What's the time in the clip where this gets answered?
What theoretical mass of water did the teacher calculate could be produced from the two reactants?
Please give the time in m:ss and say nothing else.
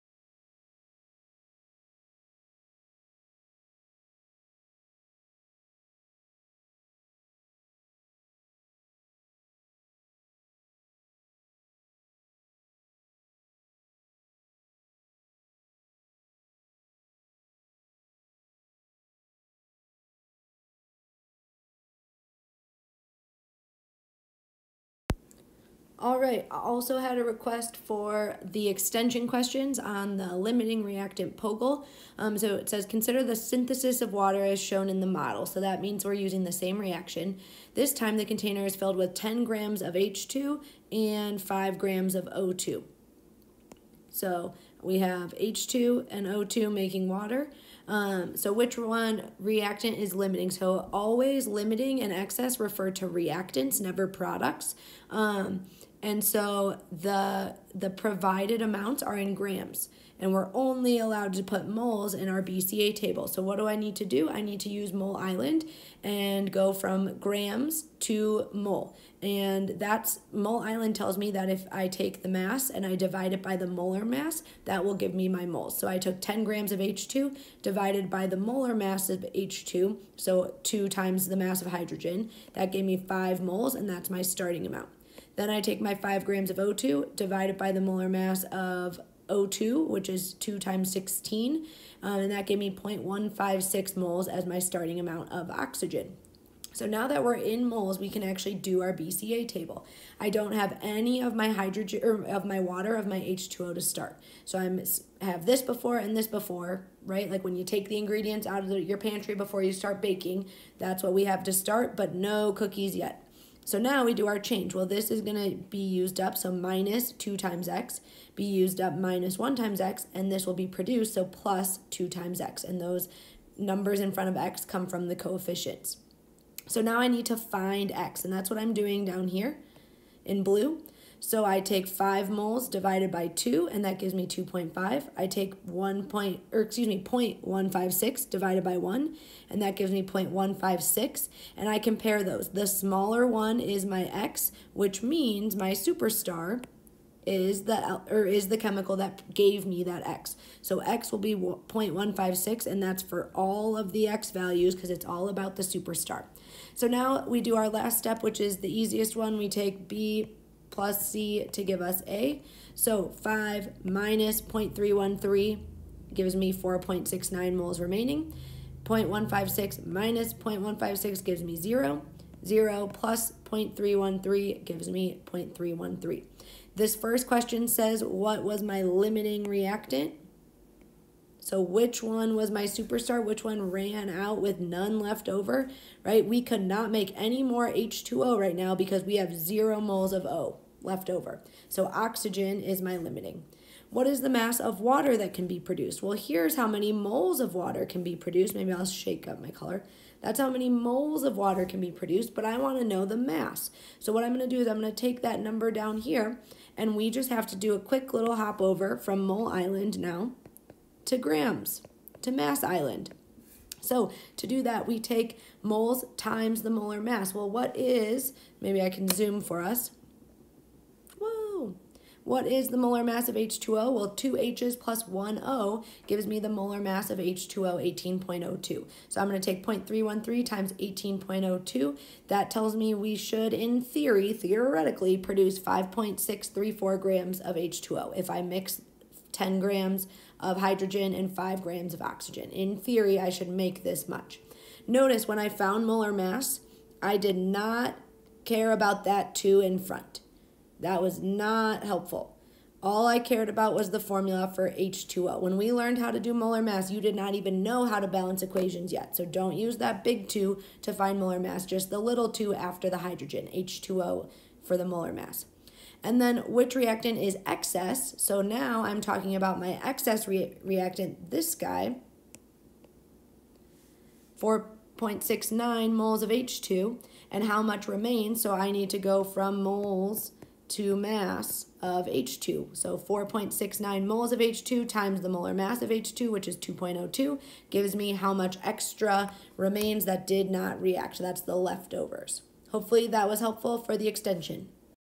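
3:55.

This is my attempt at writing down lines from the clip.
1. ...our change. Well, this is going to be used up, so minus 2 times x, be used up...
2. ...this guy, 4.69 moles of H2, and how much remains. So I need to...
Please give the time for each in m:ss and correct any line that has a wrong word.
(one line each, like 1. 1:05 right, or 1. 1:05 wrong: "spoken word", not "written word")
1. 1:54 right
2. 4:31 right.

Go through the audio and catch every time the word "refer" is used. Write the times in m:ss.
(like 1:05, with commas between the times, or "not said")
0:52.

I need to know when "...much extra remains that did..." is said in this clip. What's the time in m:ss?
4:48.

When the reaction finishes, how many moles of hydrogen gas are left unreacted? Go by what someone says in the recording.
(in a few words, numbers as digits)
4.69 moles.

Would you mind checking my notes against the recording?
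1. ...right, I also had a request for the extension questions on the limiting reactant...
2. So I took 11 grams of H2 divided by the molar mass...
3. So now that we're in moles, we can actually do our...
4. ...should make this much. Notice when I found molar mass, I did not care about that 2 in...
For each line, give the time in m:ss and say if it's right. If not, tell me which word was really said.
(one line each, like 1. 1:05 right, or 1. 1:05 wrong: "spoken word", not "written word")
1. 0:26 right
2. 1:15 wrong: "10", not "11"
3. 1:36 right
4. 4:03 right.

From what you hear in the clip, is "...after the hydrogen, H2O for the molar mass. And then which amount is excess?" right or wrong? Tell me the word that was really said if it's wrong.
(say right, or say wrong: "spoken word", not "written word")
wrong: "reactant", not "amount".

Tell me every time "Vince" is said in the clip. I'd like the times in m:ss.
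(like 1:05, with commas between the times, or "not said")
not said.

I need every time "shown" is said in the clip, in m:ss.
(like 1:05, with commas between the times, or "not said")
0:34.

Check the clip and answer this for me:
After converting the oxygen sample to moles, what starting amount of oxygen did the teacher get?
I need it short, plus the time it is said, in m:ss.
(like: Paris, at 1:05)
0.156 moles, at 1:32.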